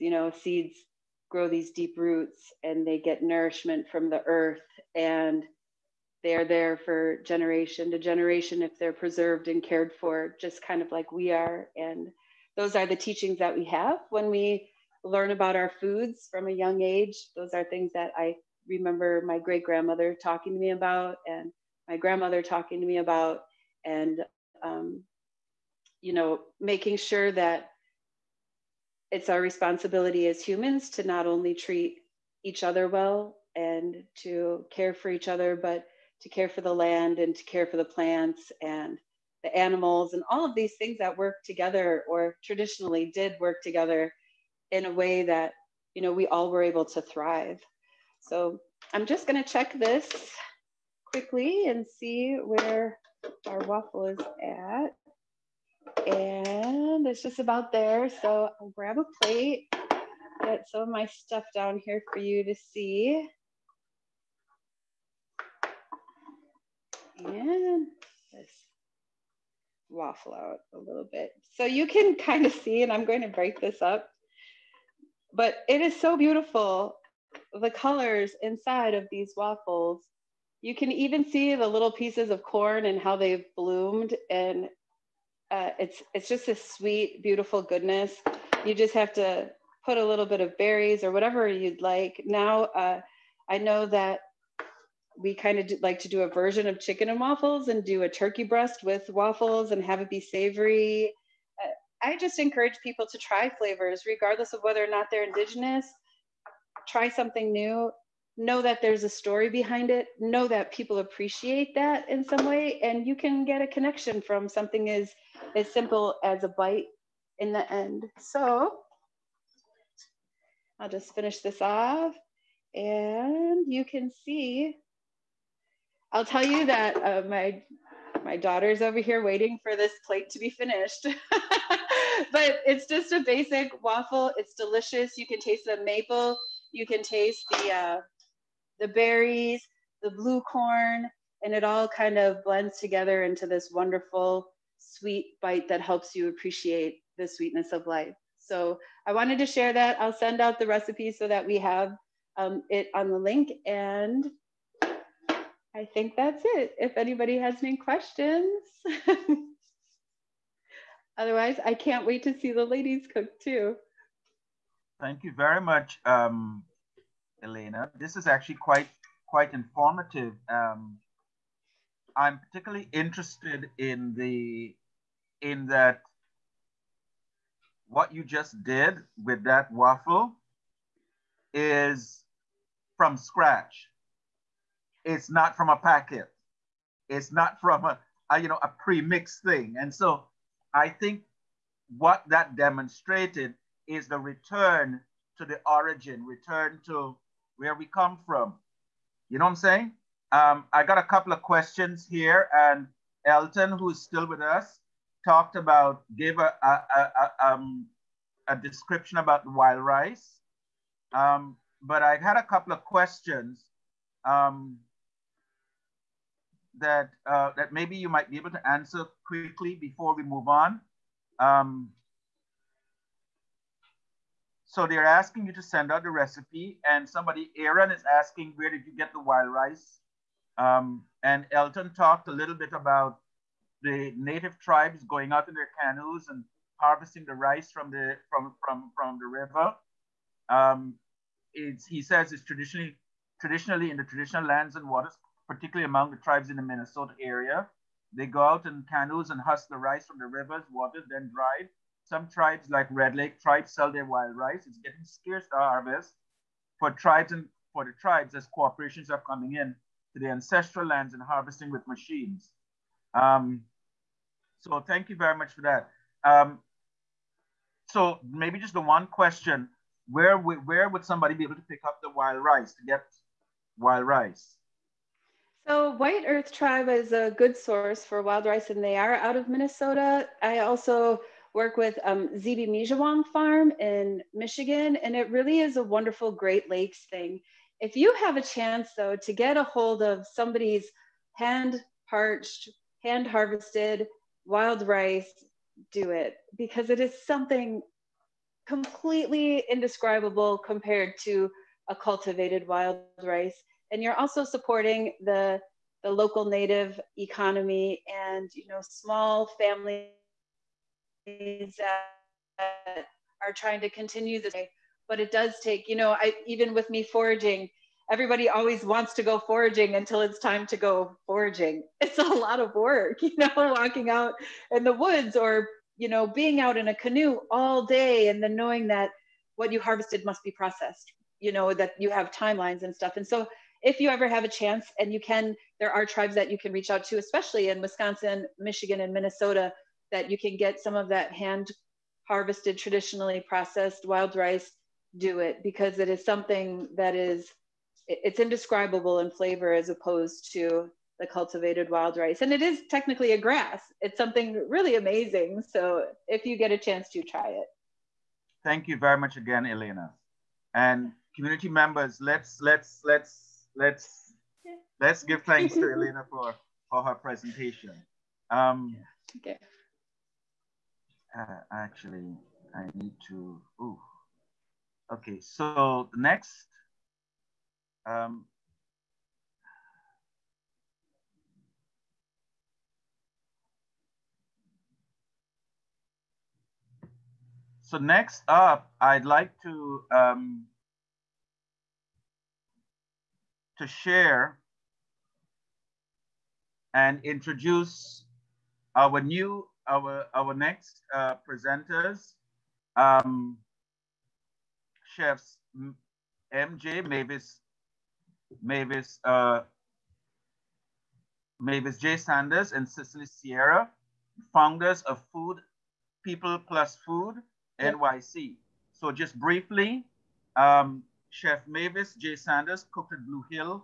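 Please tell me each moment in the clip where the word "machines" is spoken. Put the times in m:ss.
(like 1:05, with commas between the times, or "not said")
4:21.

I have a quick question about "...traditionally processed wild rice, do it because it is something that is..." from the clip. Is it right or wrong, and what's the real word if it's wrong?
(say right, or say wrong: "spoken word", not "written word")
right.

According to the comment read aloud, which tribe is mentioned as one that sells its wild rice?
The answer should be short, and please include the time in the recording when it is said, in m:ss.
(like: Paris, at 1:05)
Red Lake, at 4:12.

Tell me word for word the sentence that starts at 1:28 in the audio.
You just have to put a little bit of berries or whatever you'd like.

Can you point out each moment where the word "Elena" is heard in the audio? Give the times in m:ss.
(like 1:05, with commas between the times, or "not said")
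2:47, 5:59, 6:05.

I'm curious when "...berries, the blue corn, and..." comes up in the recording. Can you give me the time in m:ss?
2:18.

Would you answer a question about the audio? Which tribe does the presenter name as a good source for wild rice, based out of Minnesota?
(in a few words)
White Earth.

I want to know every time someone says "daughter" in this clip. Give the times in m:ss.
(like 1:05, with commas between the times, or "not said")
2:08.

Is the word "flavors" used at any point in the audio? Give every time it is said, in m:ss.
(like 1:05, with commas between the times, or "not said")
1:43, 5:49.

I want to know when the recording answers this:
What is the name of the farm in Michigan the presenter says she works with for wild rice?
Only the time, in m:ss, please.
4:42.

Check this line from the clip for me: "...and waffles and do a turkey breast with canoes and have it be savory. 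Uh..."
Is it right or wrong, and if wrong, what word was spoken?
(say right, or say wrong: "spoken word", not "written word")
wrong: "waffles", not "canoes".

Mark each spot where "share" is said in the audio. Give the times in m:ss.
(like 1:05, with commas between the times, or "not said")
2:29, 6:33.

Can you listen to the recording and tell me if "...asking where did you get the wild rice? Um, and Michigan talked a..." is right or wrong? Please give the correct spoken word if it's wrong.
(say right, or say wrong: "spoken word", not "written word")
wrong: "Elton", not "Michigan".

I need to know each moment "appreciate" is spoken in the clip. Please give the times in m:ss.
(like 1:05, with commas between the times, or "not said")
1:50, 2:26.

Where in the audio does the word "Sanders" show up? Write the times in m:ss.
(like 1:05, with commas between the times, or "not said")
6:52, 7:02.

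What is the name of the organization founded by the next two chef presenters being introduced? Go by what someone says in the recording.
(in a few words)
Food People Plus Food NYC.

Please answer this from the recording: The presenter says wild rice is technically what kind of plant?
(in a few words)
a grass.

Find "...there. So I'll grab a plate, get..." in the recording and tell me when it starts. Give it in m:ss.
0:57.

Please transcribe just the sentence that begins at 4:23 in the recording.
Um, so thank you very much for that.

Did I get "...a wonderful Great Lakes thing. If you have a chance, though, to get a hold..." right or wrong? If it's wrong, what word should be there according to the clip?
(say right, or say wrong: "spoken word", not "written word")
right.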